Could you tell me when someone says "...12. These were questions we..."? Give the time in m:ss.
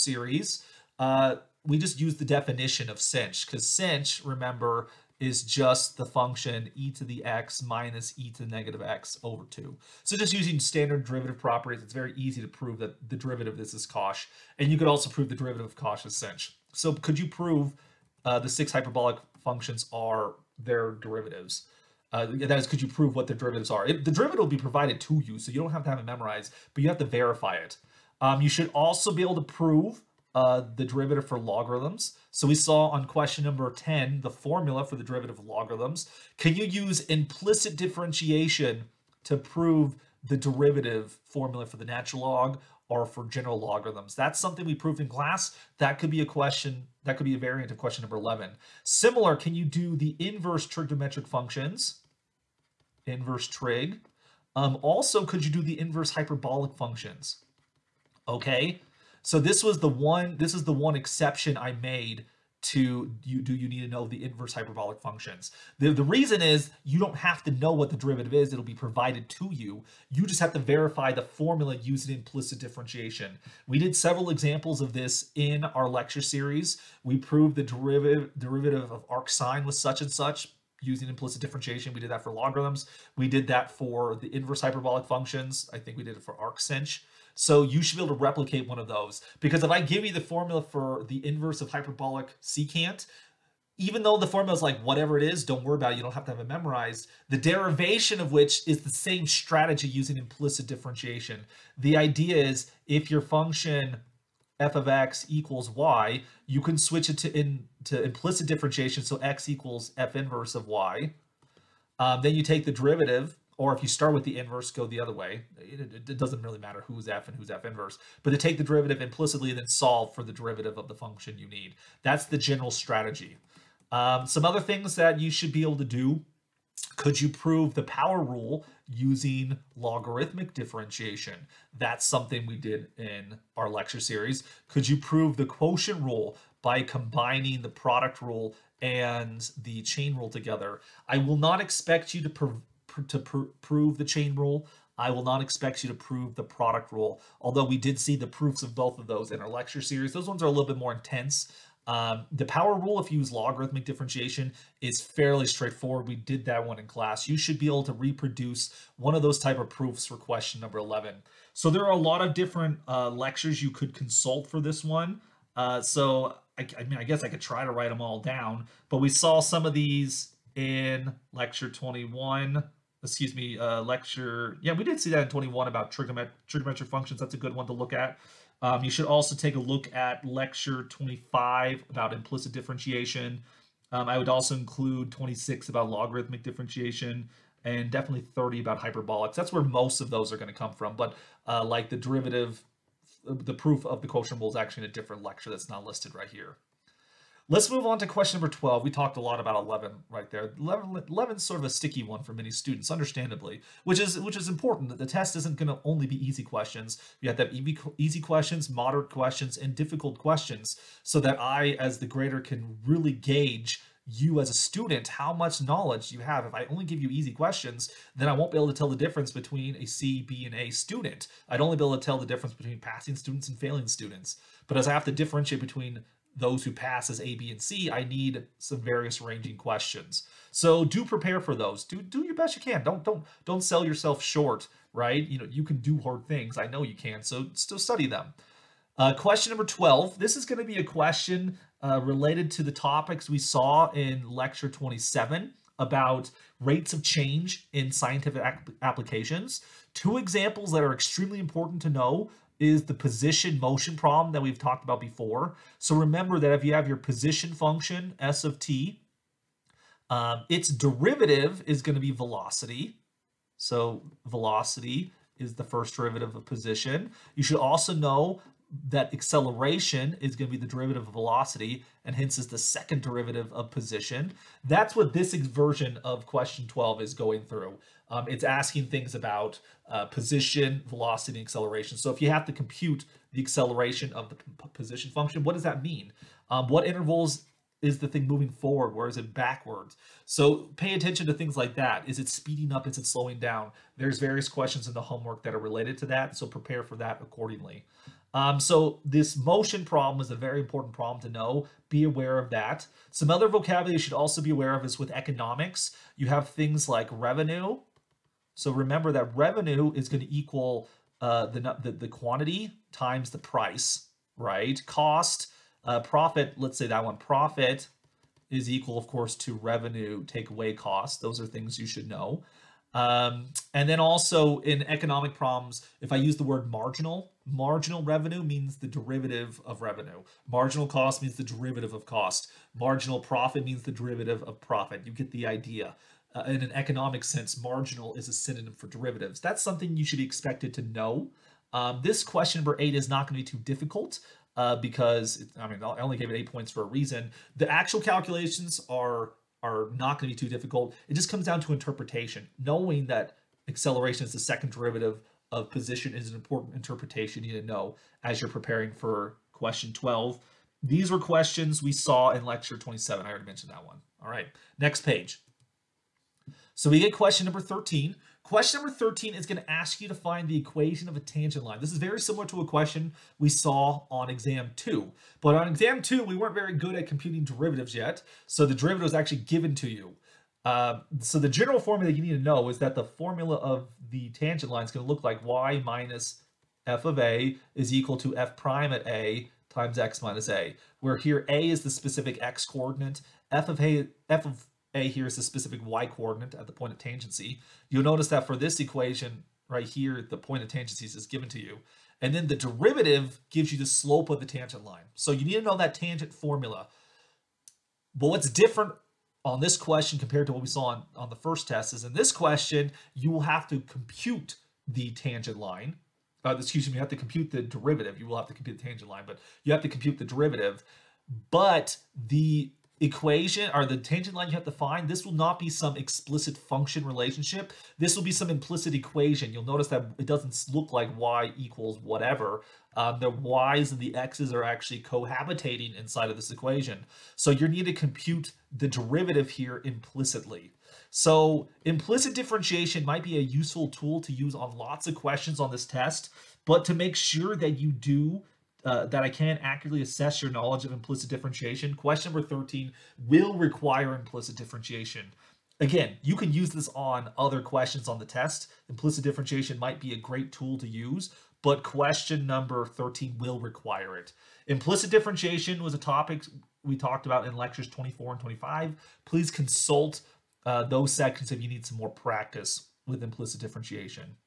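5:59.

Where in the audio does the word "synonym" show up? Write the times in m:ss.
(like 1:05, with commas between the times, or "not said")
5:38.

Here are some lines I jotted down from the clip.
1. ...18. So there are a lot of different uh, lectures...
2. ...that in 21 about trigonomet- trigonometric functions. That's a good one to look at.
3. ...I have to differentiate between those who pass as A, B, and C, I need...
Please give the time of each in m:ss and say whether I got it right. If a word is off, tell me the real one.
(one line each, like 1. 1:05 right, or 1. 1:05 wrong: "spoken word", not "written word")
1. 2:40 wrong: "11", not "18"
2. 2:55 right
3. 3:44 right.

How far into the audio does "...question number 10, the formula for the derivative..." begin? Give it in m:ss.
0:33.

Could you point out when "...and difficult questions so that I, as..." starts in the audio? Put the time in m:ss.
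3:29.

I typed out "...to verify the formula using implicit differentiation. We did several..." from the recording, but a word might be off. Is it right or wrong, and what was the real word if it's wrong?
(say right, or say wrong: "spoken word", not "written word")
right.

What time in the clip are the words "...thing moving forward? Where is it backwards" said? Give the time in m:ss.
4:48.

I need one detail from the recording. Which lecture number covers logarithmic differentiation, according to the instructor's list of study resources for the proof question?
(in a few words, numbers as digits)
26.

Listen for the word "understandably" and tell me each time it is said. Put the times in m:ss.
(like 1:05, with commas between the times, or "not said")
3:22.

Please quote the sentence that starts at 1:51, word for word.
Um, then you take the derivative, or if you start with the inverse, go the other way.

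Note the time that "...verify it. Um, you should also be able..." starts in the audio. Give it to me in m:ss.
0:27.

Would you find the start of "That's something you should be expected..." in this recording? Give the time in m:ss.
5:39.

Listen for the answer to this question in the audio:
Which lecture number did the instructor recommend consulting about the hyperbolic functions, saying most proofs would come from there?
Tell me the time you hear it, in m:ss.
3:07.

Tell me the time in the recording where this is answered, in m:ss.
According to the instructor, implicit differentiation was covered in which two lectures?
7:47.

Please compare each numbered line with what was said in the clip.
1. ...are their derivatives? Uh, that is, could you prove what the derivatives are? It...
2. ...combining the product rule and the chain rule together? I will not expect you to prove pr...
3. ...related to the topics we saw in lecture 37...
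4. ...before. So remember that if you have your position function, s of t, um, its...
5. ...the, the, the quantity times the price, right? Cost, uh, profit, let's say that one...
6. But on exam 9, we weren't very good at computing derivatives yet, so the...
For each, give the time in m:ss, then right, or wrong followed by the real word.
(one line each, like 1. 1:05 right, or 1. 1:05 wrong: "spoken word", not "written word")
1. 0:19 right
2. 2:16 right
3. 4:02 wrong: "27", not "37"
4. 4:15 right
5. 5:11 right
6. 6:15 wrong: "2", not "9".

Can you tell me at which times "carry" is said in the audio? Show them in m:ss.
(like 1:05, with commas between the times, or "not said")
not said.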